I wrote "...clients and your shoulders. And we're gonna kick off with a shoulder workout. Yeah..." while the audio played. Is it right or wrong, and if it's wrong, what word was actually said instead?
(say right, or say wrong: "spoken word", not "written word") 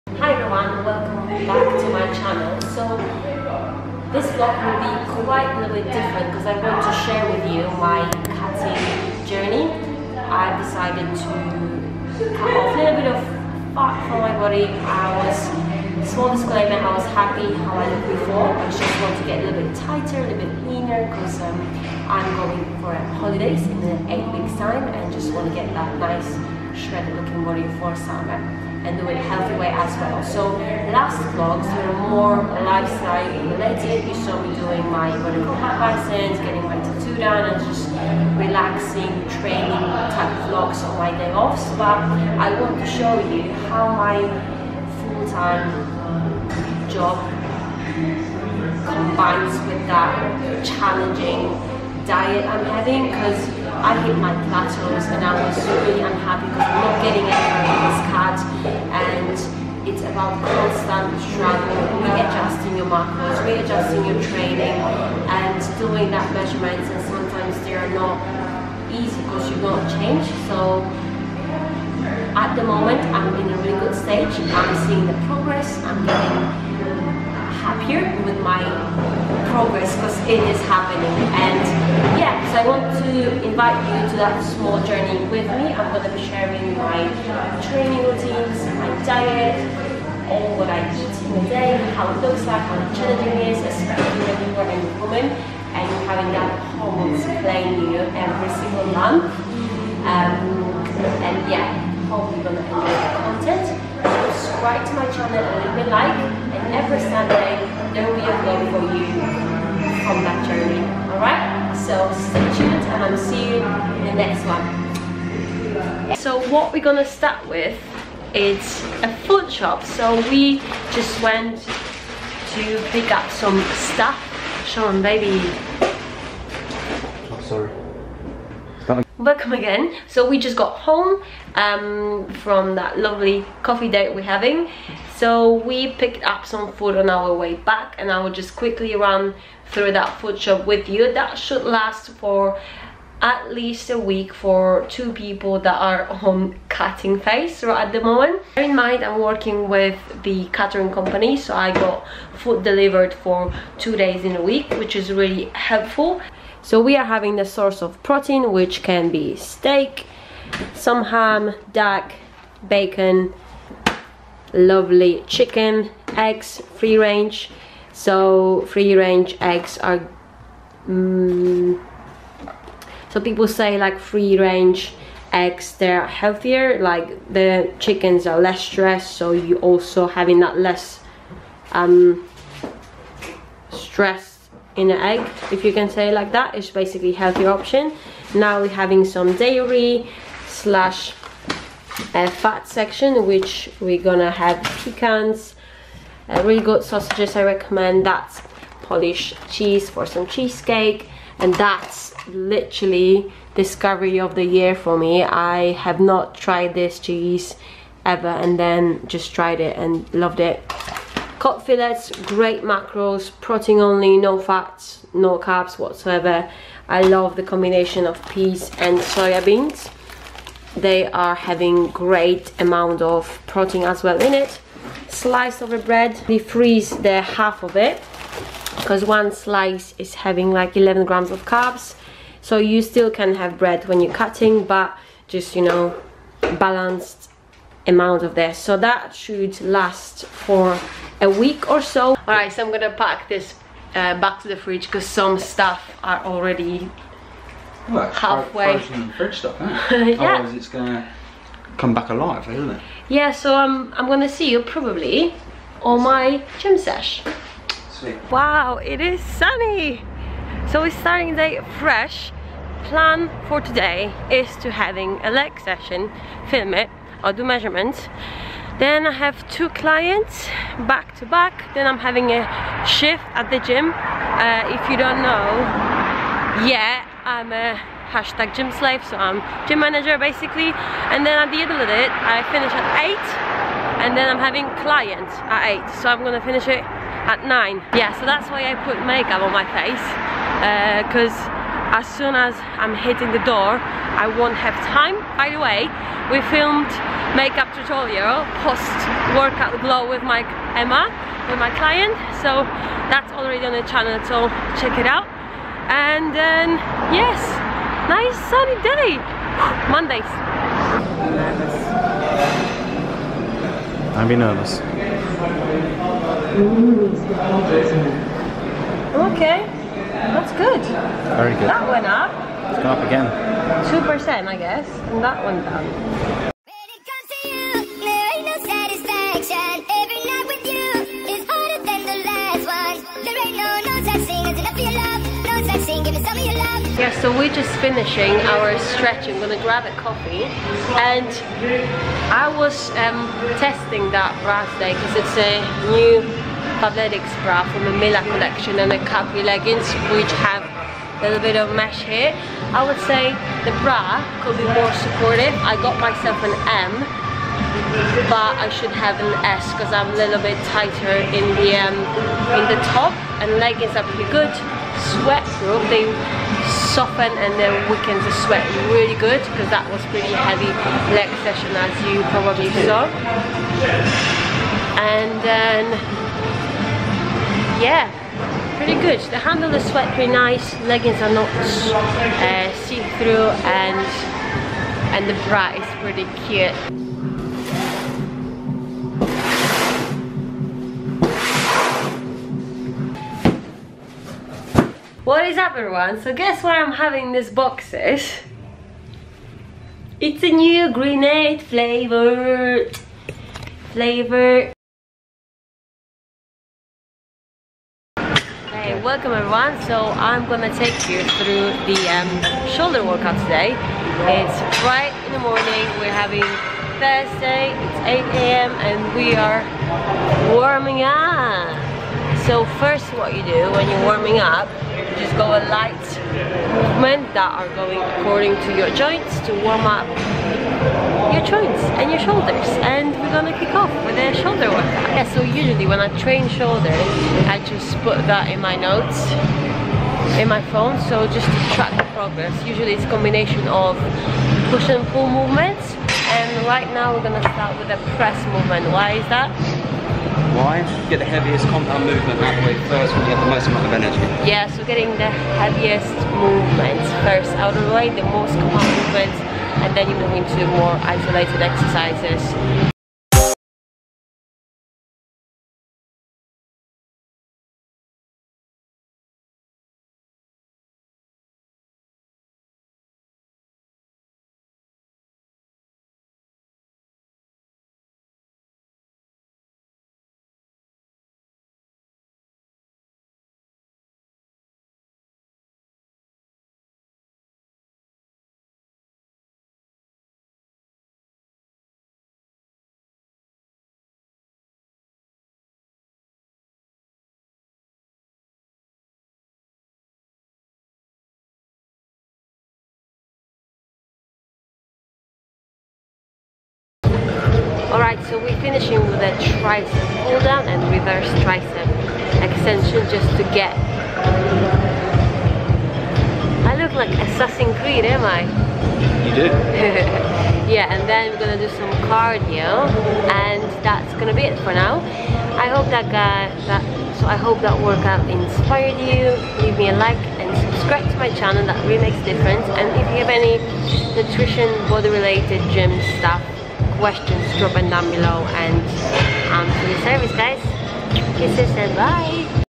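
wrong: "joints", not "clients".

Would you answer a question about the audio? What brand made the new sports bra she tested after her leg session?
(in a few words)
Fabletics.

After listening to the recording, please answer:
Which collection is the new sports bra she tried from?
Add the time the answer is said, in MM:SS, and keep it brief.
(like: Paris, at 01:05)
Mila, at 05:47.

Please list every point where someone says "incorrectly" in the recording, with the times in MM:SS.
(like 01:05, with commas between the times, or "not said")
not said.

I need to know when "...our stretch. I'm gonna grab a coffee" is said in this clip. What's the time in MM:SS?
05:38.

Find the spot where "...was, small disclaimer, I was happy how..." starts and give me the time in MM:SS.
00:15.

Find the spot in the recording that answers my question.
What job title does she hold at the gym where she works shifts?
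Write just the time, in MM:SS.
04:39.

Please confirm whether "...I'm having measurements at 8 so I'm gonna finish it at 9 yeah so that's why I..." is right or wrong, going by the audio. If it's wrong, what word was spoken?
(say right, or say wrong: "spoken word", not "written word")
wrong: "clients", not "measurements".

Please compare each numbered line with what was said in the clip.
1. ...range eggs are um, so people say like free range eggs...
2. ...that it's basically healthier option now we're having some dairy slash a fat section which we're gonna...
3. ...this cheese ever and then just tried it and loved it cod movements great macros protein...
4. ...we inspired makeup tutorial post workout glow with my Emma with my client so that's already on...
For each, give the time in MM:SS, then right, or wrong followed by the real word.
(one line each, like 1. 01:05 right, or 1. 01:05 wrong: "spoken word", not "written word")
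1. 02:48 right
2. 03:06 right
3. 03:26 wrong: "fillets", not "movements"
4. 04:56 wrong: "filmed", not "inspired".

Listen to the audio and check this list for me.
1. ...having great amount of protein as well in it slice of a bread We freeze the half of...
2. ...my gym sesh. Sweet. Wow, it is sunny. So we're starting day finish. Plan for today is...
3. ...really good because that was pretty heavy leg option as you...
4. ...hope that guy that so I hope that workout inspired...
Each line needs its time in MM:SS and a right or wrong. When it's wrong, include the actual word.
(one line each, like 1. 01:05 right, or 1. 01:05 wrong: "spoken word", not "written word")
1. 03:41 right
2. 04:16 wrong: "fresh", not "finish"
3. 06:08 wrong: "session", not "option"
4. 08:45 right.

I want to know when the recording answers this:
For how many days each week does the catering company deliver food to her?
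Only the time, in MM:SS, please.
02:33.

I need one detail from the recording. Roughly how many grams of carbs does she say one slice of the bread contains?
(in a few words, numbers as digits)
11.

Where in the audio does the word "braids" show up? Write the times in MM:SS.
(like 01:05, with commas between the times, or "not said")
not said.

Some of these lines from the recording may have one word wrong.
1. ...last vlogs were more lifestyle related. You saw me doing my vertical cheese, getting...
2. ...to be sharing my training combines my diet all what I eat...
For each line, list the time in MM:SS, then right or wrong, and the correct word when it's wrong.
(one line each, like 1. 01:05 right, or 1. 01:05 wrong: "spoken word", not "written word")
1. 00:30 wrong: "license", not "cheese"
2. 01:26 wrong: "routines", not "combines".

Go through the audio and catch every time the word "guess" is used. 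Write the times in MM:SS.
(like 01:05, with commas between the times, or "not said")
05:24, 06:36.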